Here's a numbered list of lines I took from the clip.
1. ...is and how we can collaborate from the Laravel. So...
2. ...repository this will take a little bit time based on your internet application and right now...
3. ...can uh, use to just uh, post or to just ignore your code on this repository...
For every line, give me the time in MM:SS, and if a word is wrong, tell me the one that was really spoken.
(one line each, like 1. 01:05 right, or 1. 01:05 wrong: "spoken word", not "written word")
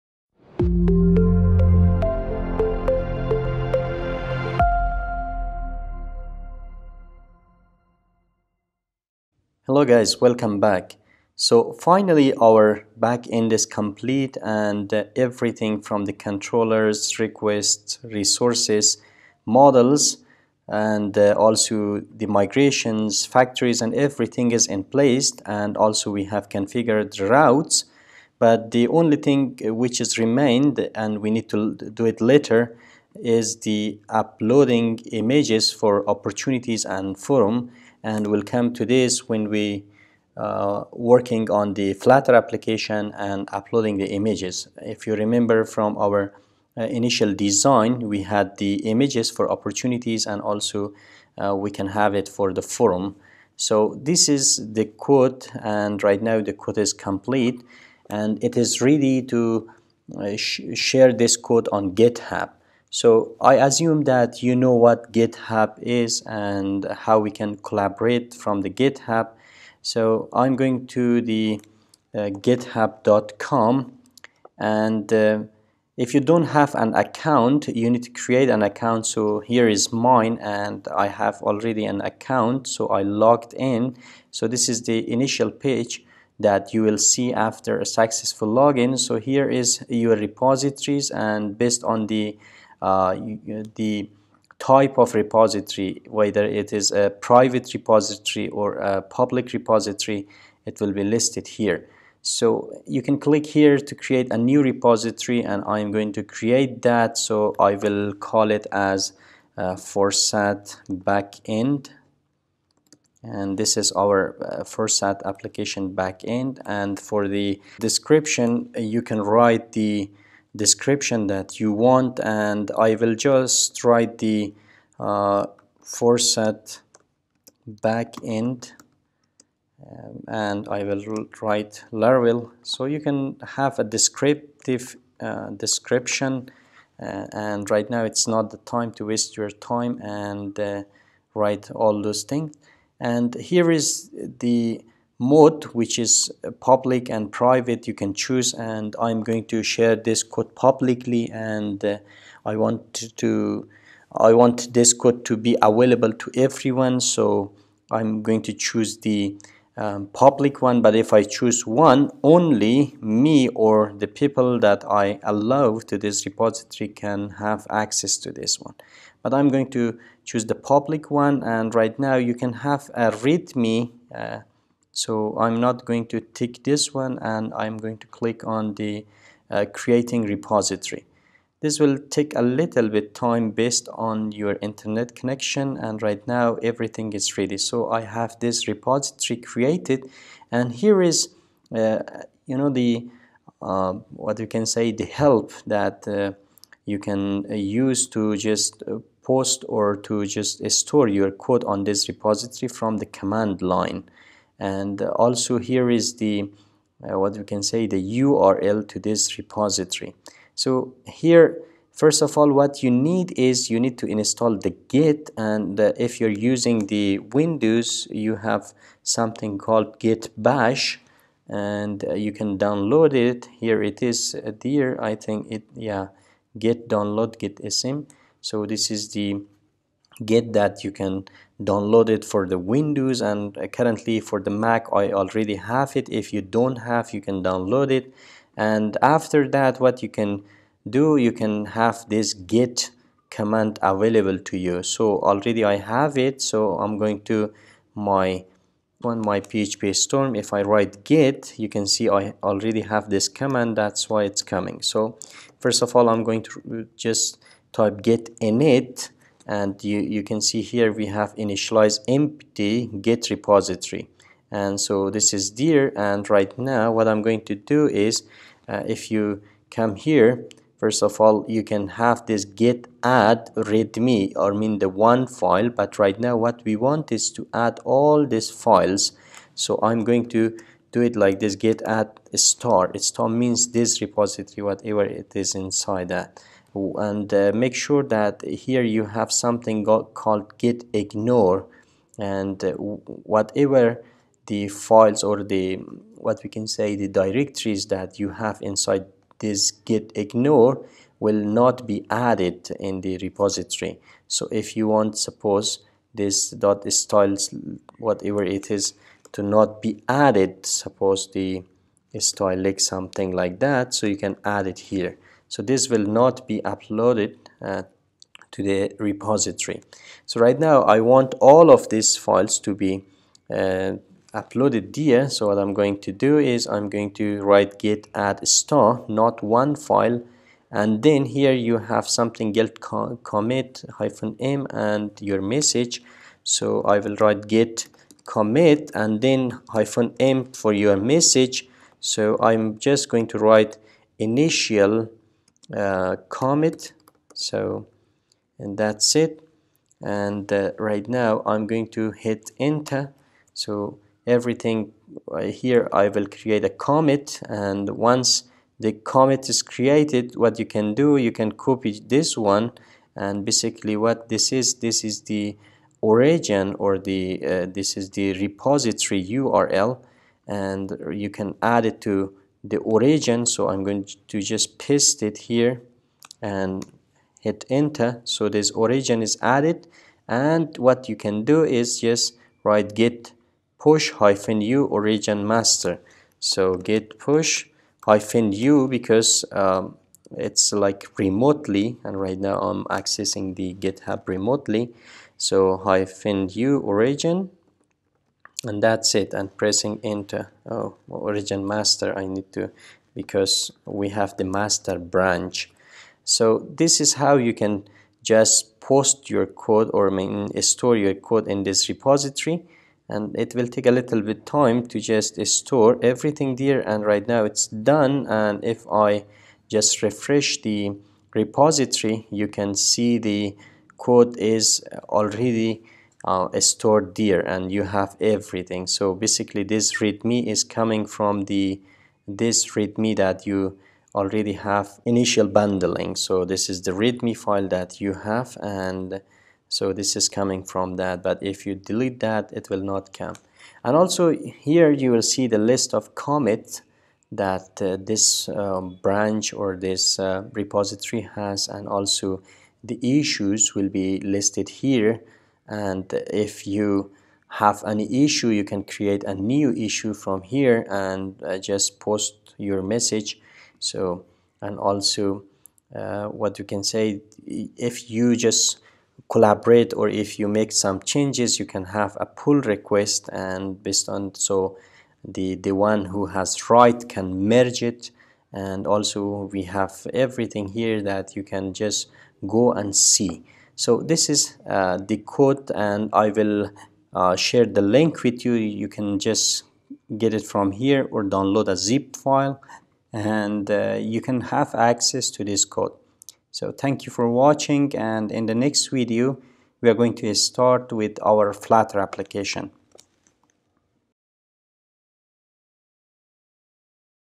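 1. 01:05 wrong: "GitHub", not "Laravel"
2. 03:00 wrong: "connection", not "application"
3. 03:16 wrong: "store", not "ignore".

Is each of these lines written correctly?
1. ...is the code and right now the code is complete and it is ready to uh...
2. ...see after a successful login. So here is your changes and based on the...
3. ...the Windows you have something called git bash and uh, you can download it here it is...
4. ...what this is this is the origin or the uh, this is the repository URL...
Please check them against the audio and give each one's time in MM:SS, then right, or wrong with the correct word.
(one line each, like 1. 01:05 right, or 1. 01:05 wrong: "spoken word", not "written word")
1. 00:54 right
2. 01:26 wrong: "repositories", not "changes"
3. 03:36 right
4. 06:03 right.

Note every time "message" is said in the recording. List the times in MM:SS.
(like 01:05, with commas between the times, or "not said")
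05:35, 05:40, 07:42.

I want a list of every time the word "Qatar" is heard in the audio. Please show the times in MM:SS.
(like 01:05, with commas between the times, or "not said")
not said.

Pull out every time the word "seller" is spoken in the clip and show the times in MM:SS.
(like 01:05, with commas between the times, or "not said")
not said.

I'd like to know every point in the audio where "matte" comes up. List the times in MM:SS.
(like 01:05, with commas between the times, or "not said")
not said.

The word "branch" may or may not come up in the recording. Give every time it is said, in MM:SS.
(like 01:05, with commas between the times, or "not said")
06:44, 07:29.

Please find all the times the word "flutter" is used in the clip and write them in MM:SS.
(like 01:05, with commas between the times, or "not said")
00:41, 08:21.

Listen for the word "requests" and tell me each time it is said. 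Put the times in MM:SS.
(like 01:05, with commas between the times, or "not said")
00:17, 07:52.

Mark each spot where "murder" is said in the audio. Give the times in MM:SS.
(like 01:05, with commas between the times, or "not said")
not said.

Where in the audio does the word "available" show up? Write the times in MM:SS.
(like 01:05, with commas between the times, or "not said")
02:35, 04:03.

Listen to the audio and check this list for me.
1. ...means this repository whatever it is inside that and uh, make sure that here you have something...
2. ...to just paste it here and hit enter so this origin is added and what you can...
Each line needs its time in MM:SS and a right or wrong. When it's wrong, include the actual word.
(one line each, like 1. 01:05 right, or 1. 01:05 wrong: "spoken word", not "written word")
1. 04:43 right
2. 06:14 right.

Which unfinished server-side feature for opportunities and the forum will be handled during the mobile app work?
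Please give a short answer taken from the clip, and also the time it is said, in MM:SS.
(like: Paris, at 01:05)
Uploading images, at 00:34.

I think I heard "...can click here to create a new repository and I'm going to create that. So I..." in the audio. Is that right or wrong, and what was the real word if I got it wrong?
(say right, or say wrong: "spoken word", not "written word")
right.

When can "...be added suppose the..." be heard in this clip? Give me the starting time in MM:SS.
05:09.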